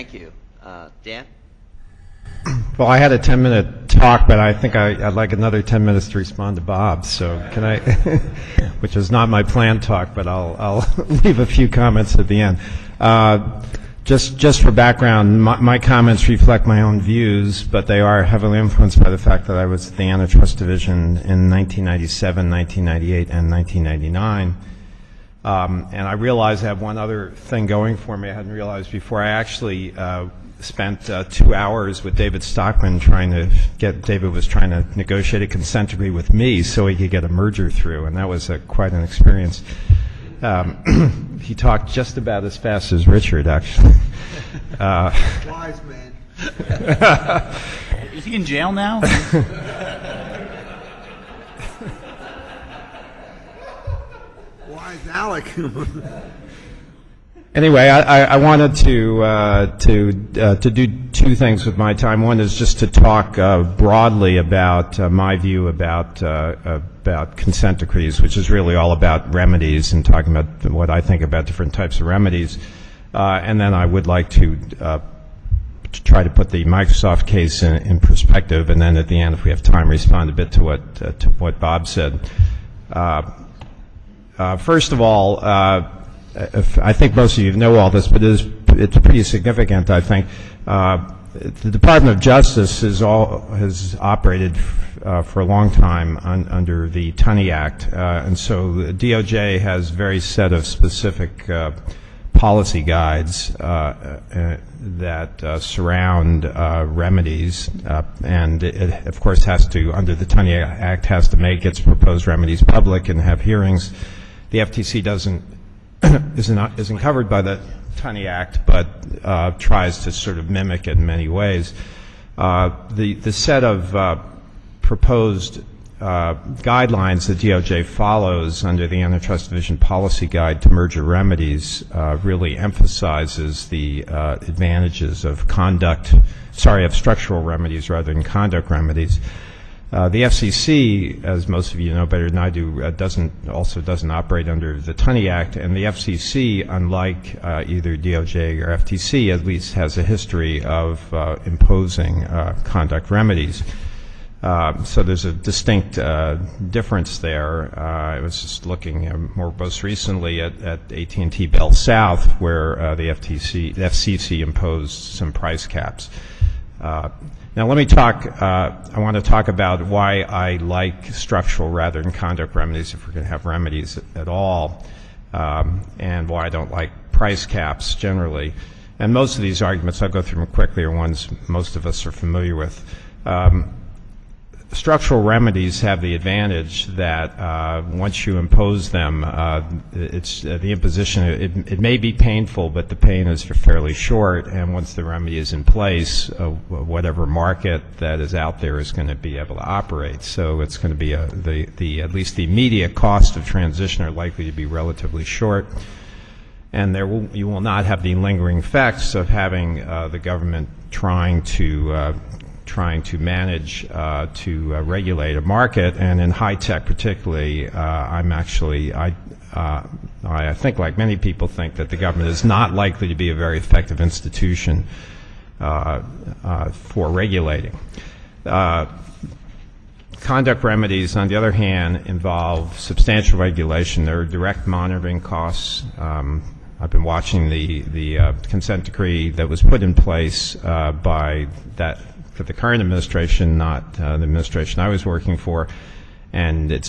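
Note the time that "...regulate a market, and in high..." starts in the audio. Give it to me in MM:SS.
03:34.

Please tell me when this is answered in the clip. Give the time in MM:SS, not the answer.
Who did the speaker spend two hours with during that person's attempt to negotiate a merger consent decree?
00:32.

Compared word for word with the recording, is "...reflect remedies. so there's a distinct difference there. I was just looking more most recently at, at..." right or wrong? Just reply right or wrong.
wrong.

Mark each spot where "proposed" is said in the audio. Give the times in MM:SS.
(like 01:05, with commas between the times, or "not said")
01:51, 02:04.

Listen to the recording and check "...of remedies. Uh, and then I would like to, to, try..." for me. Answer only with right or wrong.
right.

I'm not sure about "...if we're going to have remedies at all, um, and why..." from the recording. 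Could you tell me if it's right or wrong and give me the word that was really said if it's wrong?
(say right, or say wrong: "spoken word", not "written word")
right.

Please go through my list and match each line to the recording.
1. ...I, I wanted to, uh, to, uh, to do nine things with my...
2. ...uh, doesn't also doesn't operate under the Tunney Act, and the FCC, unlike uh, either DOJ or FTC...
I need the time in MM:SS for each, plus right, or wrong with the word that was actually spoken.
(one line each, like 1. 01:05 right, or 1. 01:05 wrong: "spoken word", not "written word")
1. 00:57 wrong: "two", not "nine"
2. 02:22 right.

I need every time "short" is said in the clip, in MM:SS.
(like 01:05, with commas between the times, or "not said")
03:13, 03:25.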